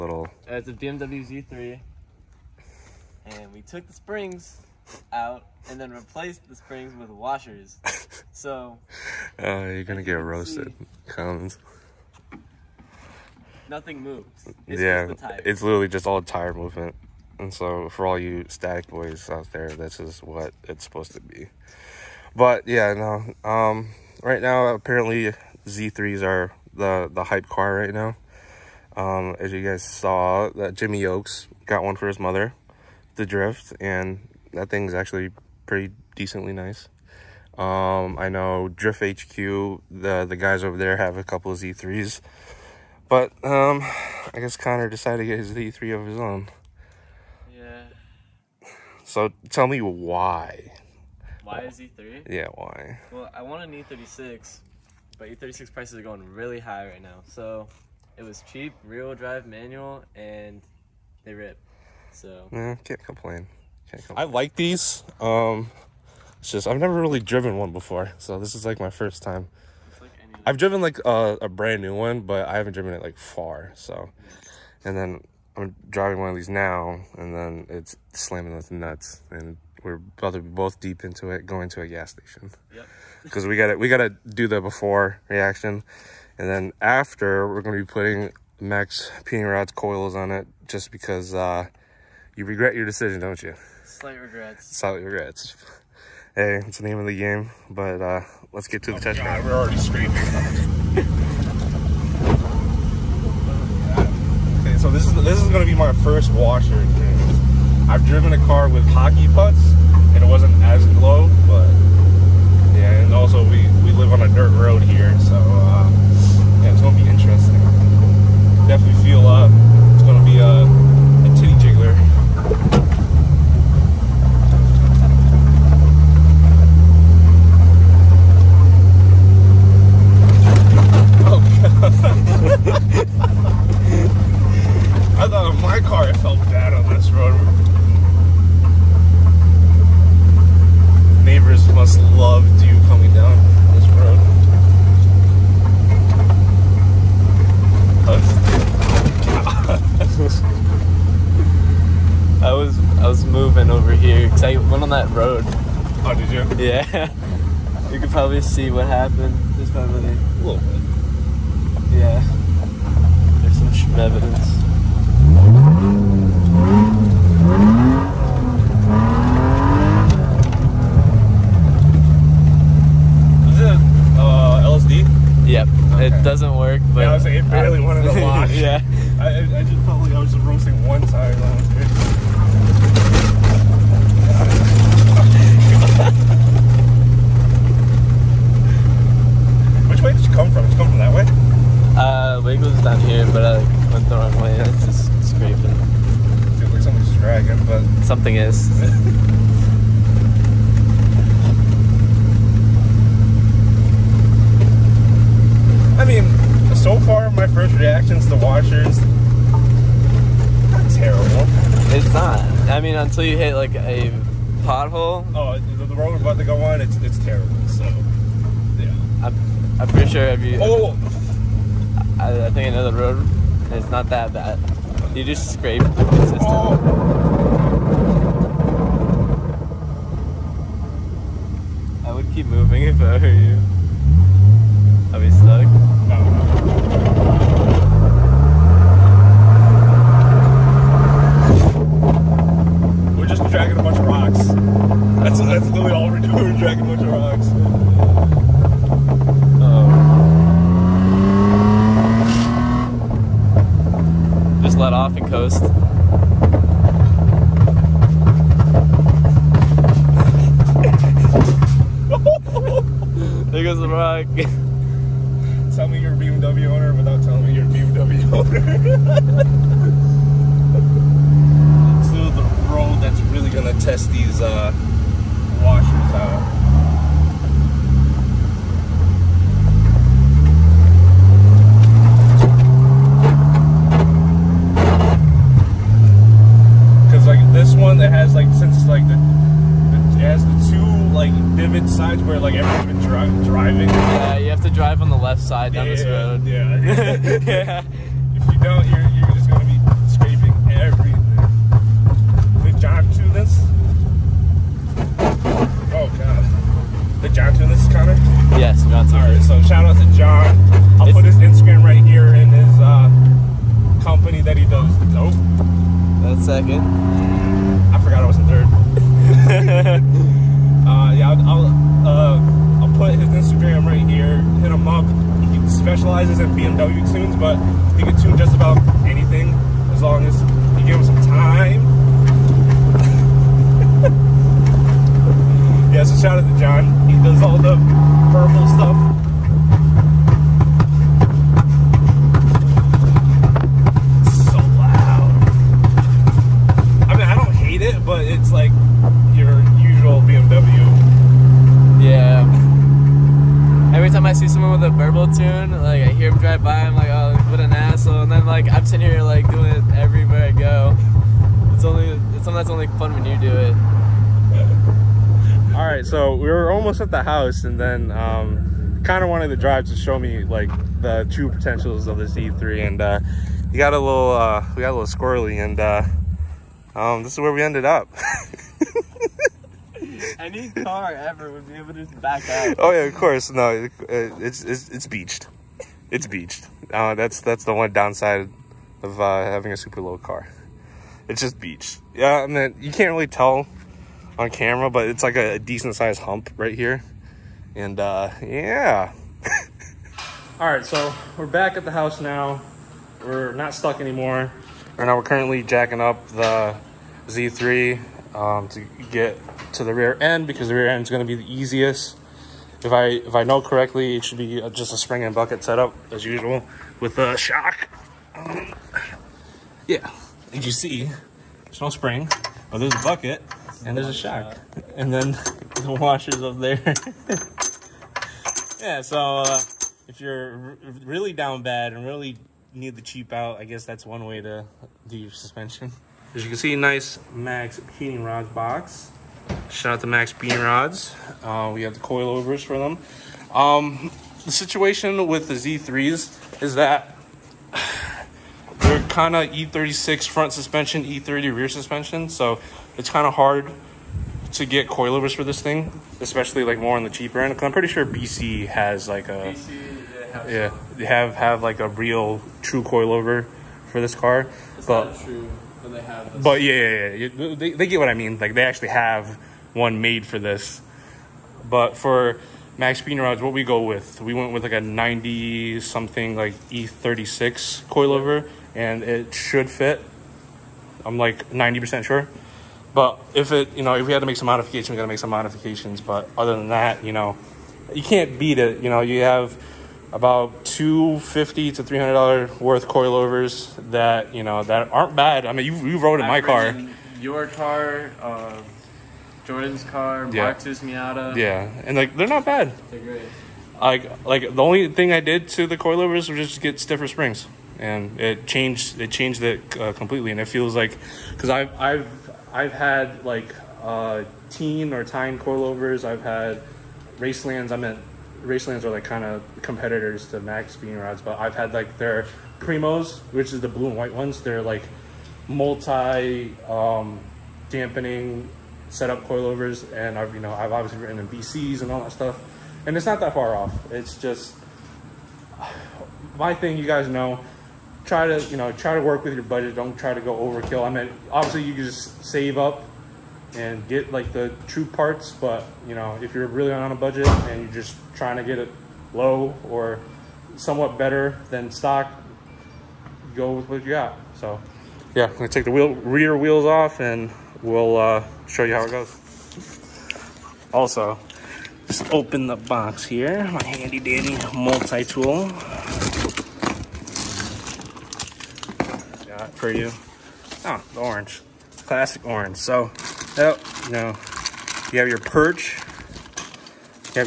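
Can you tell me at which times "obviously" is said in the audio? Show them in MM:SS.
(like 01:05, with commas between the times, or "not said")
08:50, 09:01.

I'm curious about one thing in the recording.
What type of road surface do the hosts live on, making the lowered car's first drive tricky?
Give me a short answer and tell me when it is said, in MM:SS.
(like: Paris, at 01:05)
Dirt road, at 01:54.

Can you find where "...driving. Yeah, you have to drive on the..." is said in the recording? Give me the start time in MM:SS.
04:53.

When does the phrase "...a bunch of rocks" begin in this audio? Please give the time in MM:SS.
04:06.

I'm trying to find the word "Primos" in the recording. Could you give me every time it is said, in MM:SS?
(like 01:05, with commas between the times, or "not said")
08:42.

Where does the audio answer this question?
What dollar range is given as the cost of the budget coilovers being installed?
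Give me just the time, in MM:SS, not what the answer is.
08:10.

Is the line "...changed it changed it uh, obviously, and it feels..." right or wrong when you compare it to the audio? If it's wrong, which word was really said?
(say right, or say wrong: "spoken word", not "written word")
wrong: "completely", not "obviously".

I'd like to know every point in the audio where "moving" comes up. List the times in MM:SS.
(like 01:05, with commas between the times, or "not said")
02:33, 03:52.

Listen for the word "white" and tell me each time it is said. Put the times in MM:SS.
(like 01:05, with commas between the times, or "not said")
08:43.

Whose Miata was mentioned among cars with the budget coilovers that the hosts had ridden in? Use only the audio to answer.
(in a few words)
Marx.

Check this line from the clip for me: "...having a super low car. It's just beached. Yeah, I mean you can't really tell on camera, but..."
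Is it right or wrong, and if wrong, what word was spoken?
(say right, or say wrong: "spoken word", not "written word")
right.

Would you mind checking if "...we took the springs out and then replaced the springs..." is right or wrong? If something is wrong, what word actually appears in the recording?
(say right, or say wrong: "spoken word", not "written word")
right.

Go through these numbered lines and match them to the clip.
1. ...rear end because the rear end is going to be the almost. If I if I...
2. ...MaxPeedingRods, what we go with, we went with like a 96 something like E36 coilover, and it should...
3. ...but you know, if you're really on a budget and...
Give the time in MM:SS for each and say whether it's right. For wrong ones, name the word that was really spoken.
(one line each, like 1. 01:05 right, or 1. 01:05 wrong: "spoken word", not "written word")
1. 06:49 wrong: "easiest", not "almost"
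2. 07:52 wrong: "90", not "96"
3. 09:05 right.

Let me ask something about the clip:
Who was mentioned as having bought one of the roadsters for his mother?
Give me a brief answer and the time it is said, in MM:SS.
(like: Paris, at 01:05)
Jimmy Oaks, at 00:30.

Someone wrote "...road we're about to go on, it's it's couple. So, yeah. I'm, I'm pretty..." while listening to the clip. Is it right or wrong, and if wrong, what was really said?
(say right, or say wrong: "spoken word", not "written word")
wrong: "terrible", not "couple".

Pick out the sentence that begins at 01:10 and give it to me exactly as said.
I've driven like a, a, brand new one, but I haven't driven it like far.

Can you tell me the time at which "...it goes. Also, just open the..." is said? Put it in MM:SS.
09:18.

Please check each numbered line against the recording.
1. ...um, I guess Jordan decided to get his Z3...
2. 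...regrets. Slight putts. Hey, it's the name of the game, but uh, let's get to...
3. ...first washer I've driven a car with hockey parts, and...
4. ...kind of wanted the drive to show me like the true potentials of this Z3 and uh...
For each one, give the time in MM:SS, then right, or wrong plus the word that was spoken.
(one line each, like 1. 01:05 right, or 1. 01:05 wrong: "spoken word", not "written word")
1. 00:43 wrong: "Connor", not "Jordan"
2. 01:34 wrong: "regrets", not "putts"
3. 01:46 wrong: "putts", not "parts"
4. 06:09 right.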